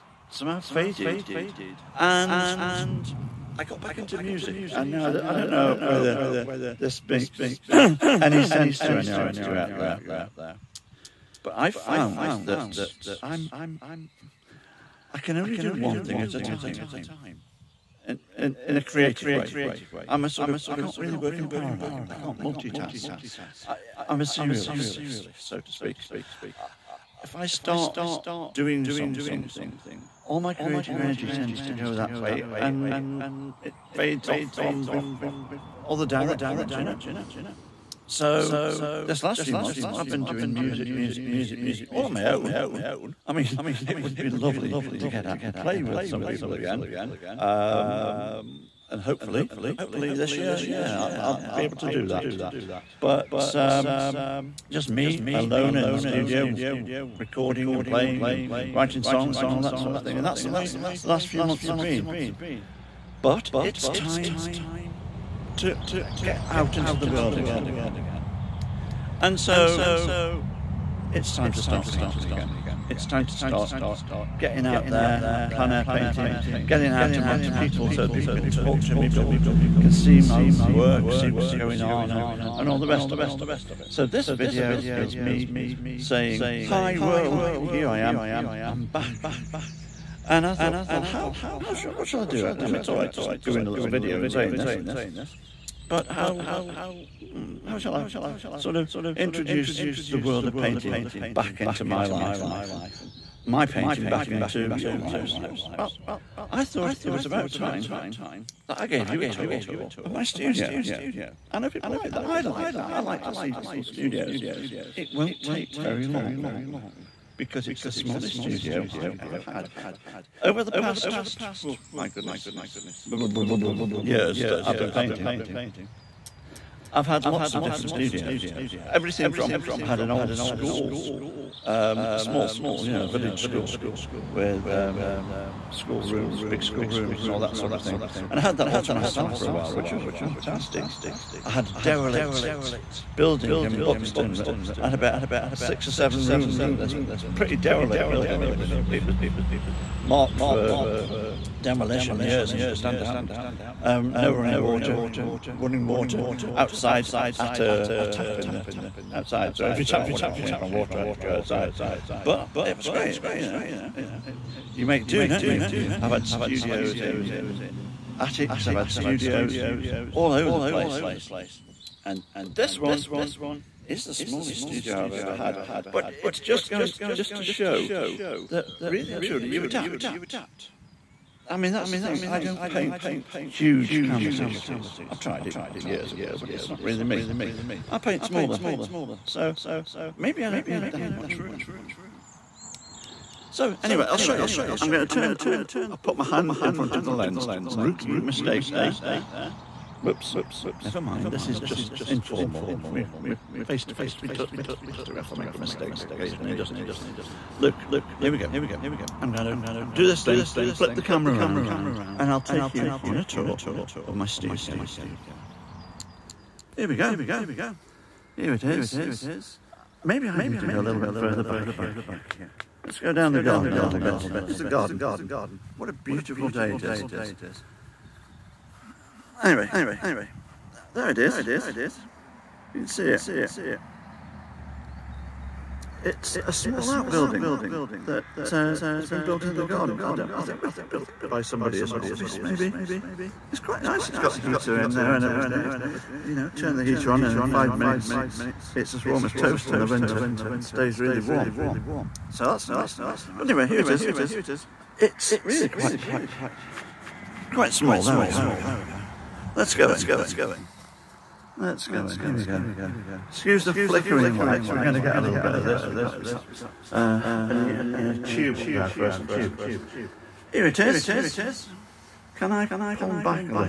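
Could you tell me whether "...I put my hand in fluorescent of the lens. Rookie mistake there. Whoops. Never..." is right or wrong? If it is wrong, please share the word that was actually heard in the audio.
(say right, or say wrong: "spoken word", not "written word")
wrong: "front", not "fluorescent".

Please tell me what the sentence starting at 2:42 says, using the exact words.
But it was great, you know.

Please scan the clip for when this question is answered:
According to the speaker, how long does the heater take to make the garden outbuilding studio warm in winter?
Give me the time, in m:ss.
4:07.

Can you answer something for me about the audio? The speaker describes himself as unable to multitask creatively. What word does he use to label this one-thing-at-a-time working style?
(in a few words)
serialist.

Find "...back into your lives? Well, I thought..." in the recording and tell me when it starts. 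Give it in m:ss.
1:44.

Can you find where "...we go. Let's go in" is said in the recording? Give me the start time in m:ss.
4:18.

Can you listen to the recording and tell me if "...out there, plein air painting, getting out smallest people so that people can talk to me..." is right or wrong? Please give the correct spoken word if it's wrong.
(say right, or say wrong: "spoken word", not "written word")
wrong: "amongst", not "smallest".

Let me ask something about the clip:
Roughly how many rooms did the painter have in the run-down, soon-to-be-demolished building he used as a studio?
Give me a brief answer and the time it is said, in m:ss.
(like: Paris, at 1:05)
6 or 7, at 2:25.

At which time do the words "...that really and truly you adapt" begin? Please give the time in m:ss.
2:58.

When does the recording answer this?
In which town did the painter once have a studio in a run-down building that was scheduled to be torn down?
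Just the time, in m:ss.
2:23.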